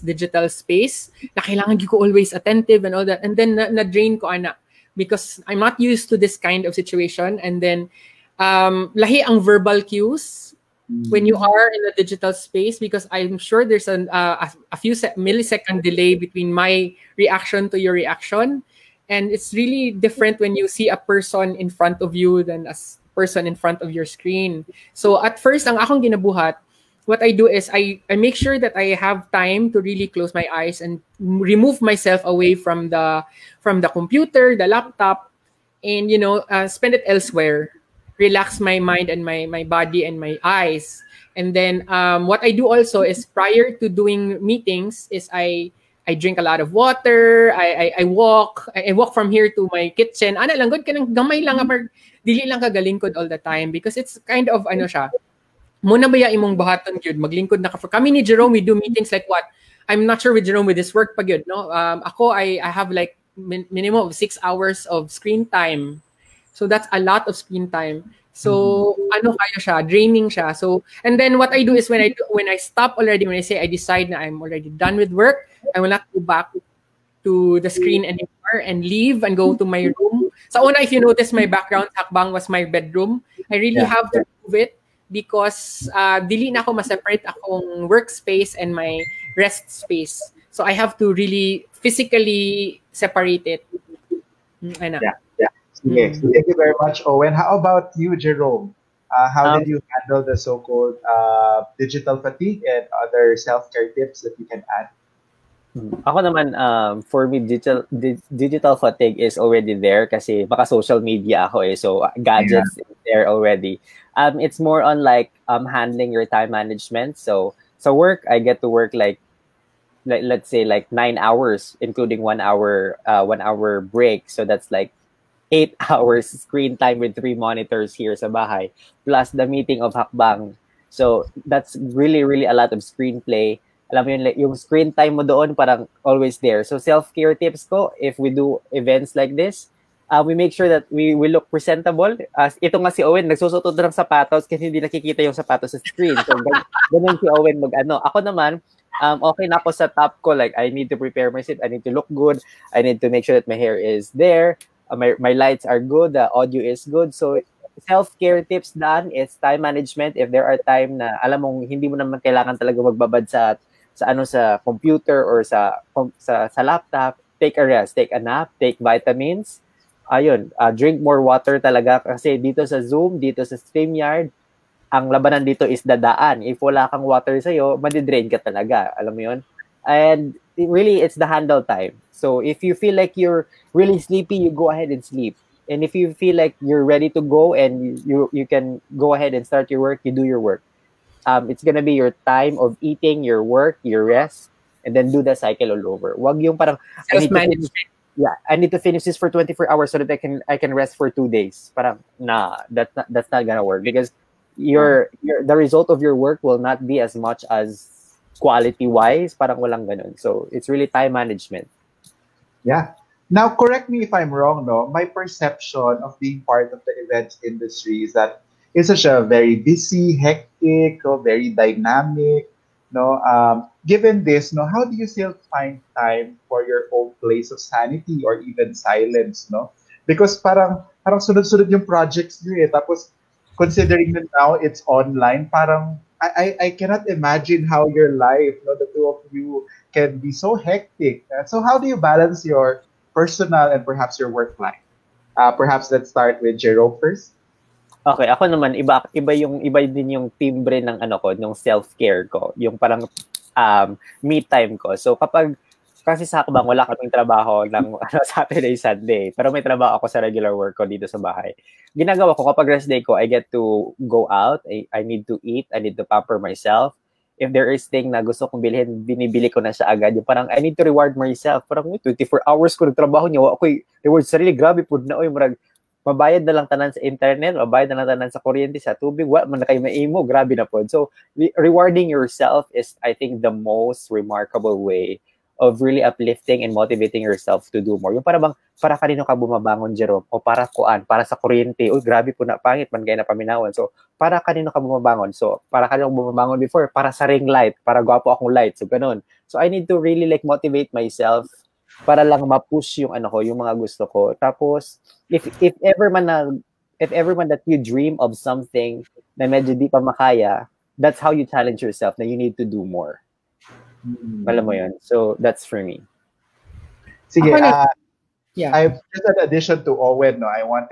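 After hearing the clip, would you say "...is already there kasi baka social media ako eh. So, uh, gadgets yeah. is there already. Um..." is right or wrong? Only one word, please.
right.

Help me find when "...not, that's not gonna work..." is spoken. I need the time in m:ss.
3:22.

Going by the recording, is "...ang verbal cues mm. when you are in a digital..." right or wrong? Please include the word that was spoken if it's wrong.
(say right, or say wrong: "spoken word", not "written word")
right.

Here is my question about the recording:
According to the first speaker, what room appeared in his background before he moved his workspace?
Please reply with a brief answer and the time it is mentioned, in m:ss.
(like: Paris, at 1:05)
Bedroom, at 1:22.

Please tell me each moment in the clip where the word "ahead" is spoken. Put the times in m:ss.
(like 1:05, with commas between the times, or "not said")
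3:04, 3:09.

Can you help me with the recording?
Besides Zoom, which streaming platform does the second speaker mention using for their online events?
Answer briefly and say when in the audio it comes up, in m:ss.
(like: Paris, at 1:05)
StreamYard, at 2:53.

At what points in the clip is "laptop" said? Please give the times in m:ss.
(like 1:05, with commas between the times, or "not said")
0:34, 2:46.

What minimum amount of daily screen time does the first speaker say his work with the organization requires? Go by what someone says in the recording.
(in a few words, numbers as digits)
6 hours.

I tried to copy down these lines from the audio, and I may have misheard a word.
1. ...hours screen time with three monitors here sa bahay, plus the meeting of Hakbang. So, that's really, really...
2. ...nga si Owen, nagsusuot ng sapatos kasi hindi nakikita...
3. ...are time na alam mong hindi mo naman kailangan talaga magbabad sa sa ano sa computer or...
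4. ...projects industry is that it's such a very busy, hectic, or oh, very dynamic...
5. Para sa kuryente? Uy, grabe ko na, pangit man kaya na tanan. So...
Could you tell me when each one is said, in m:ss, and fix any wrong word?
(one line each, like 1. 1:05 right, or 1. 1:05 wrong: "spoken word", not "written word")
1. 2:05 right
2. 2:22 right
3. 2:40 right
4. 3:37 wrong: "events", not "projects"
5. 4:51 wrong: "paminawan", not "tanan".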